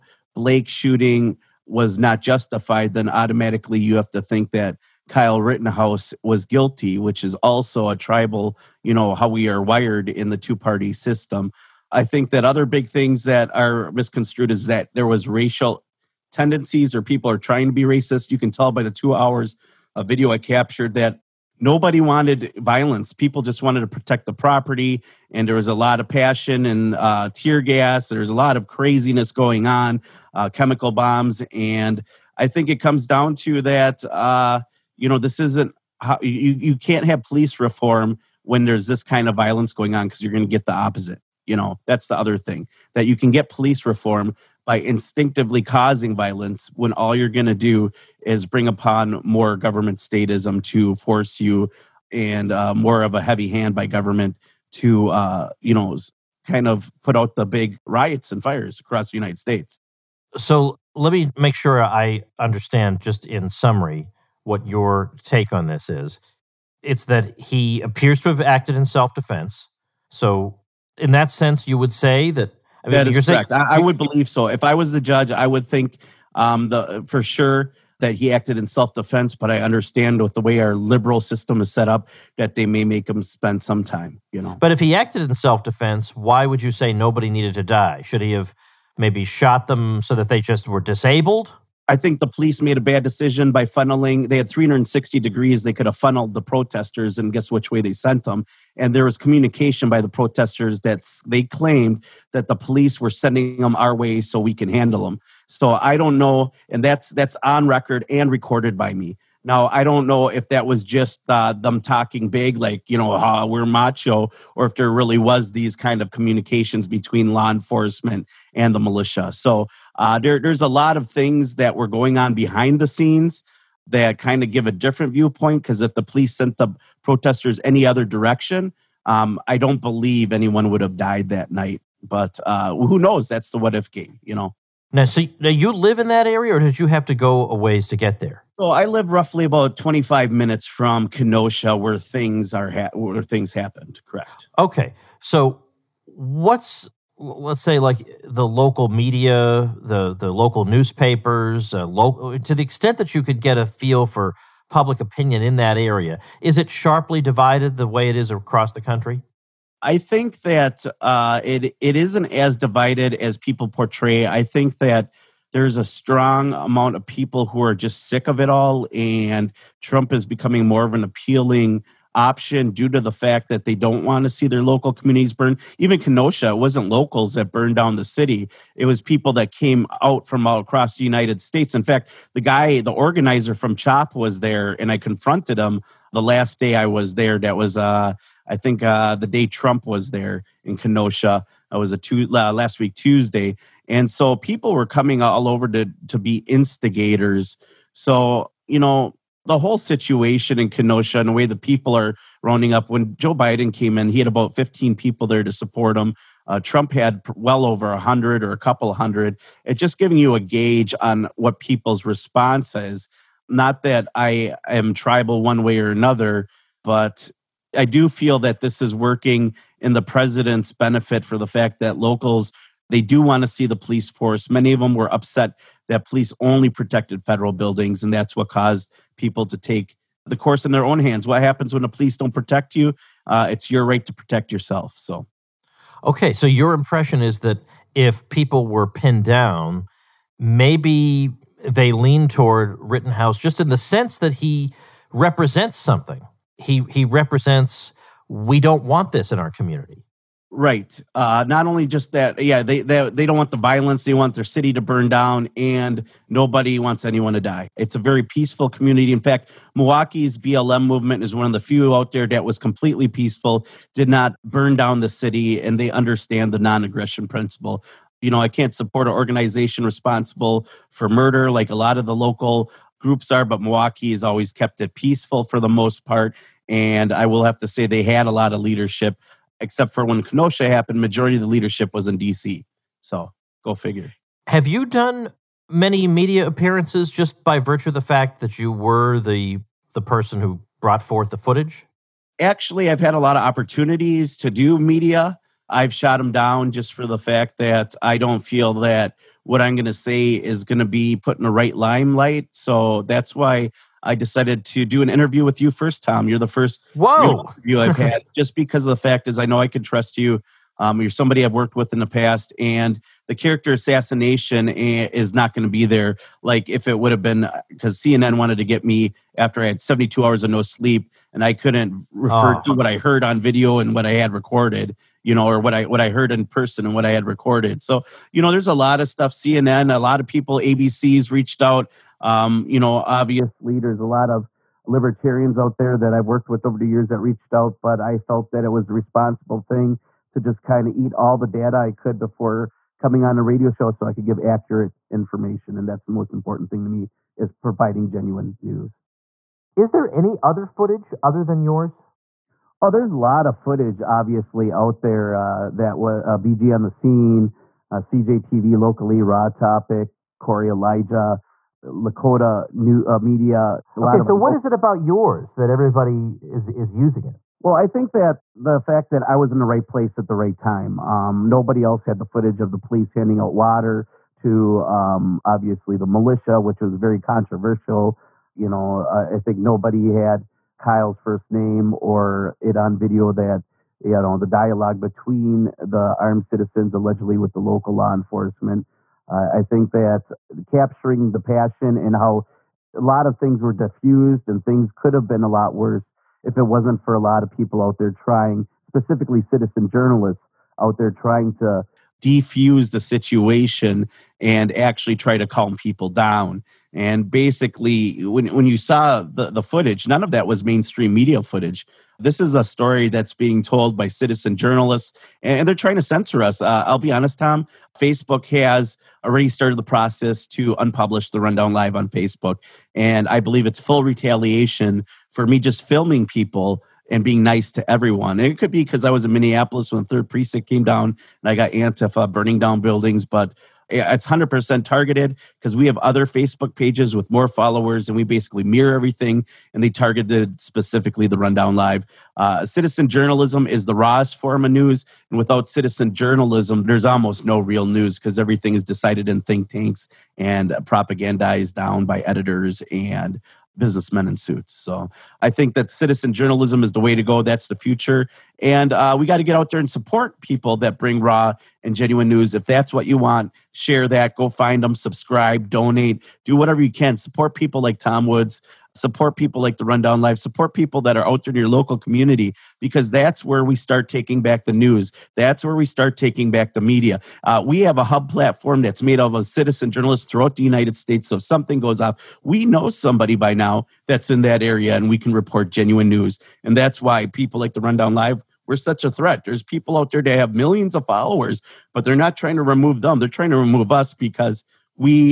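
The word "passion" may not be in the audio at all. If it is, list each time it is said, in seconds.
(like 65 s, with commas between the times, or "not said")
26 s, 391 s.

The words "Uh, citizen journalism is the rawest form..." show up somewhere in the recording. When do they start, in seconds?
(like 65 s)
442 s.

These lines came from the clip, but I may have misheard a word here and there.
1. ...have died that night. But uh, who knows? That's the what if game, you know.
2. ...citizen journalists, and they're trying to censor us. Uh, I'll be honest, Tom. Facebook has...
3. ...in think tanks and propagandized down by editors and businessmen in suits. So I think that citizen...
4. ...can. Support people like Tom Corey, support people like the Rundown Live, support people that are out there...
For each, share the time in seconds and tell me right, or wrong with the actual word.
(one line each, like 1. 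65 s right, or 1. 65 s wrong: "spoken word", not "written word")
1. 130 s right
2. 414 s right
3. 449 s right
4. 466 s wrong: "Woods", not "Corey".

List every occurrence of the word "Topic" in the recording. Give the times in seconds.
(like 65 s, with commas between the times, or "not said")
359 s.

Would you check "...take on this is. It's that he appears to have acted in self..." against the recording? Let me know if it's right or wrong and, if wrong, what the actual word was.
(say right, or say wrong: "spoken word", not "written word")
right.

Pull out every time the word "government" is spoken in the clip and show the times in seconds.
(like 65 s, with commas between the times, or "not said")
49 s, 53 s.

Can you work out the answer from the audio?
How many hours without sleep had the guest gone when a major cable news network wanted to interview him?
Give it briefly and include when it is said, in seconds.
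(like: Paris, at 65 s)
72, at 319 s.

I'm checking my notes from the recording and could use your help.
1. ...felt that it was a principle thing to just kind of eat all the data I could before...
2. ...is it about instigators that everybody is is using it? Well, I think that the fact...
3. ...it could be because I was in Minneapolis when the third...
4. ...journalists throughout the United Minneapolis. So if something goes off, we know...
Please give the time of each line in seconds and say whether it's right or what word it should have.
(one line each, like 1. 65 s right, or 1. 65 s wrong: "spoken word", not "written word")
1. 338 s wrong: "responsible", not "principle"
2. 364 s wrong: "yours", not "instigators"
3. 428 s right
4. 479 s wrong: "States", not "Minneapolis".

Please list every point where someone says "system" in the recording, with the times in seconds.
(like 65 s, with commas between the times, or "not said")
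10 s, 81 s.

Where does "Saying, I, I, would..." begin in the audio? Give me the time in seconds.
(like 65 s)
73 s.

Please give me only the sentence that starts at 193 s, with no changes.
And so people were coming all over to, to be instigators.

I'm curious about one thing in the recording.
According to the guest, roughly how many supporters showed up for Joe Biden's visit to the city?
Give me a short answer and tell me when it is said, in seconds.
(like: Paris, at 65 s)
15, at 204 s.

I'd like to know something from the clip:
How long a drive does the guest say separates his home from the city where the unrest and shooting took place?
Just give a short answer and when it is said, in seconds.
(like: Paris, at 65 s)
25 minutes, at 139 s.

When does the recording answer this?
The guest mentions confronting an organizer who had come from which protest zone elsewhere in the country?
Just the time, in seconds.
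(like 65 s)
183 s.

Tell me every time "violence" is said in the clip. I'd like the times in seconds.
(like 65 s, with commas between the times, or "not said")
22 s, 39 s, 46 s, 253 s.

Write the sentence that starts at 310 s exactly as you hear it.
Um, you're somebody I've worked with in the past, and the character assassination eh, is not going to be there.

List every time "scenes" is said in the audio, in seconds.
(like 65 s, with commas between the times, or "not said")
122 s, 356 s.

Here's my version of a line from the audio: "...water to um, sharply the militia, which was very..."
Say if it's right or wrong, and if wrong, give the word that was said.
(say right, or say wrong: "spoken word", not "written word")
wrong: "obviously", not "sharply".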